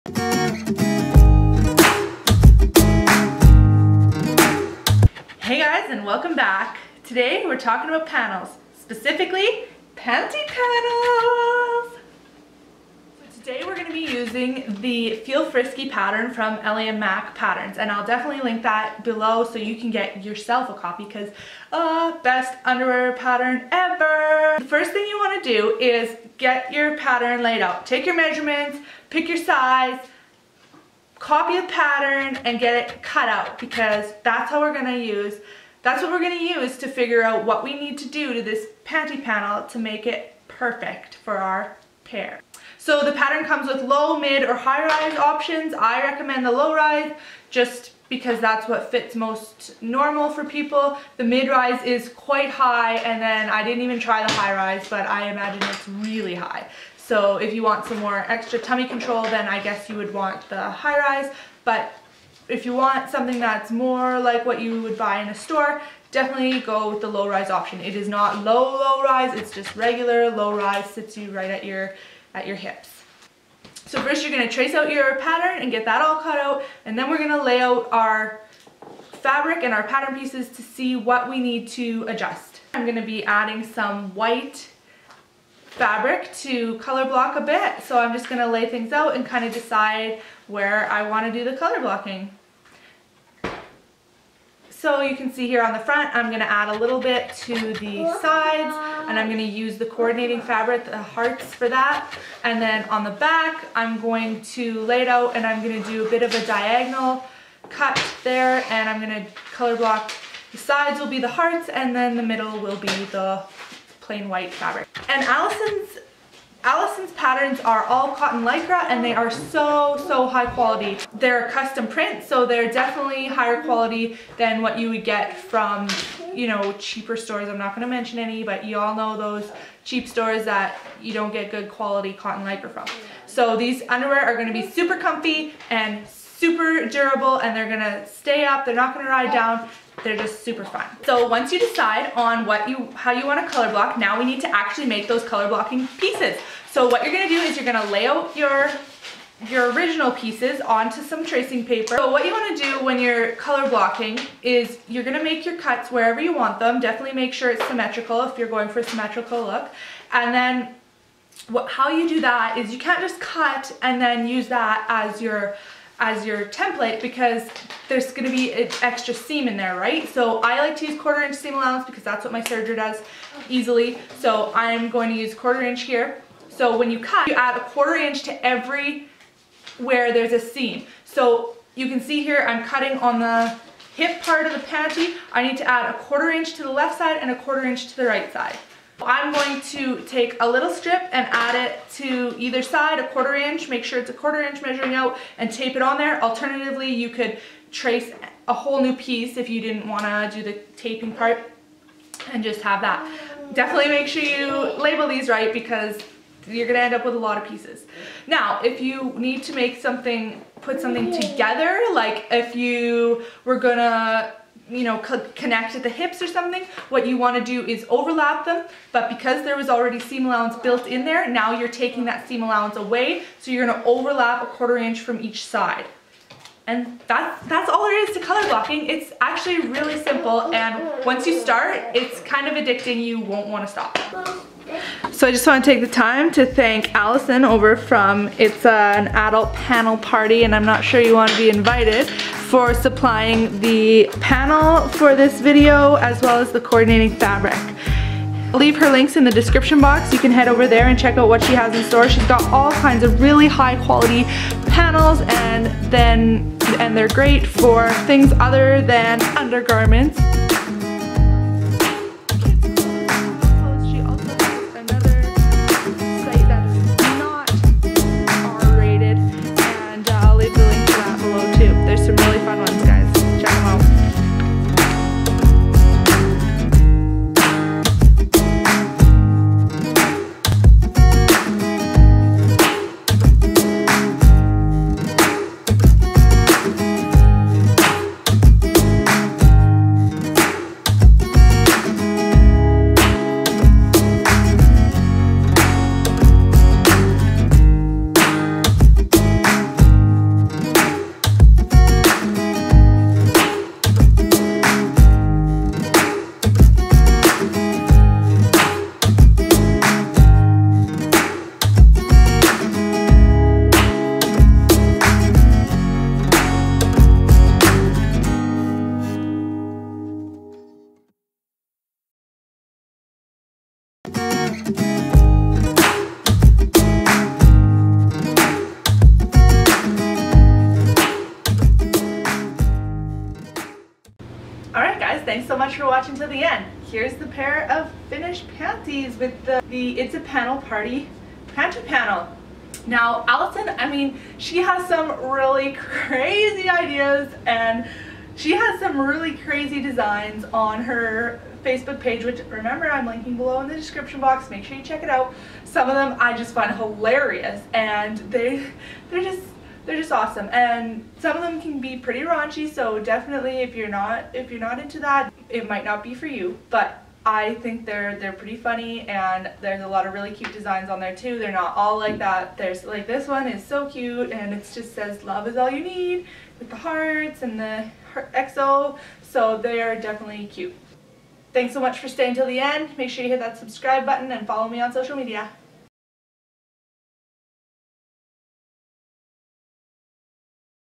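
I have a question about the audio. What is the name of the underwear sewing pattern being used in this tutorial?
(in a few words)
Feel Frisky.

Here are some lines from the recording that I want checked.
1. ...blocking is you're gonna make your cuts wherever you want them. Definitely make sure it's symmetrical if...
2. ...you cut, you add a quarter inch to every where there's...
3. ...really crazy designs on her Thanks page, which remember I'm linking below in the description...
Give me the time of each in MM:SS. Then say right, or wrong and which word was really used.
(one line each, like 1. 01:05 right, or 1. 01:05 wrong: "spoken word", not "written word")
1. 02:33 right
2. 02:56 right
3. 05:48 wrong: "Facebook", not "Thanks".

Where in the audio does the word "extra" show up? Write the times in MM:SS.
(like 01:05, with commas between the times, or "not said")
00:58, 02:48.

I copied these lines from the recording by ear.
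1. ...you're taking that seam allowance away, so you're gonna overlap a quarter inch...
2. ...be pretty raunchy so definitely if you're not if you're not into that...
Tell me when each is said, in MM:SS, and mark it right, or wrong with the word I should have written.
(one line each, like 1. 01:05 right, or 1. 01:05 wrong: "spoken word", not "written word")
1. 03:41 right
2. 06:01 right.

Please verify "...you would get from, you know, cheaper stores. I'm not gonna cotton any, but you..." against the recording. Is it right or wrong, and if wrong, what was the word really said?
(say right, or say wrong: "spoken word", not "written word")
wrong: "mention", not "cotton".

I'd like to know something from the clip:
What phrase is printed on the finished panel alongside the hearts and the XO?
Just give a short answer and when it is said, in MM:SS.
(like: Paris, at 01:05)
love is all you need, at 06:15.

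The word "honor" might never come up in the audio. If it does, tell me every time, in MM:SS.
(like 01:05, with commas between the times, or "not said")
not said.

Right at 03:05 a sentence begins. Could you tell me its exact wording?
I need to add a quarter inch to the left side and a quarter inch to the right side.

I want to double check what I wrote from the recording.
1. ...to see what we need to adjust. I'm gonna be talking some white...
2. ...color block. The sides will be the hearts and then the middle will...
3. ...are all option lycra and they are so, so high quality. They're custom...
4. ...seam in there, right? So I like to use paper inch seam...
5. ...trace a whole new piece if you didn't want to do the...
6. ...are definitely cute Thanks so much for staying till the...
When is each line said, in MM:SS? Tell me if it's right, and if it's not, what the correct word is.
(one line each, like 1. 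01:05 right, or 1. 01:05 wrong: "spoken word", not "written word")
1. 01:20 wrong: "adding", not "talking"
2. 01:49 right
3. 01:57 wrong: "cotton", not "option"
4. 02:49 wrong: "quarter", not "paper"
5. 03:17 right
6. 06:19 right.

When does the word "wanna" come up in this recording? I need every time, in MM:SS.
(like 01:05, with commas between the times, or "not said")
01:31, 02:23, 02:32, 03:37, 03:53.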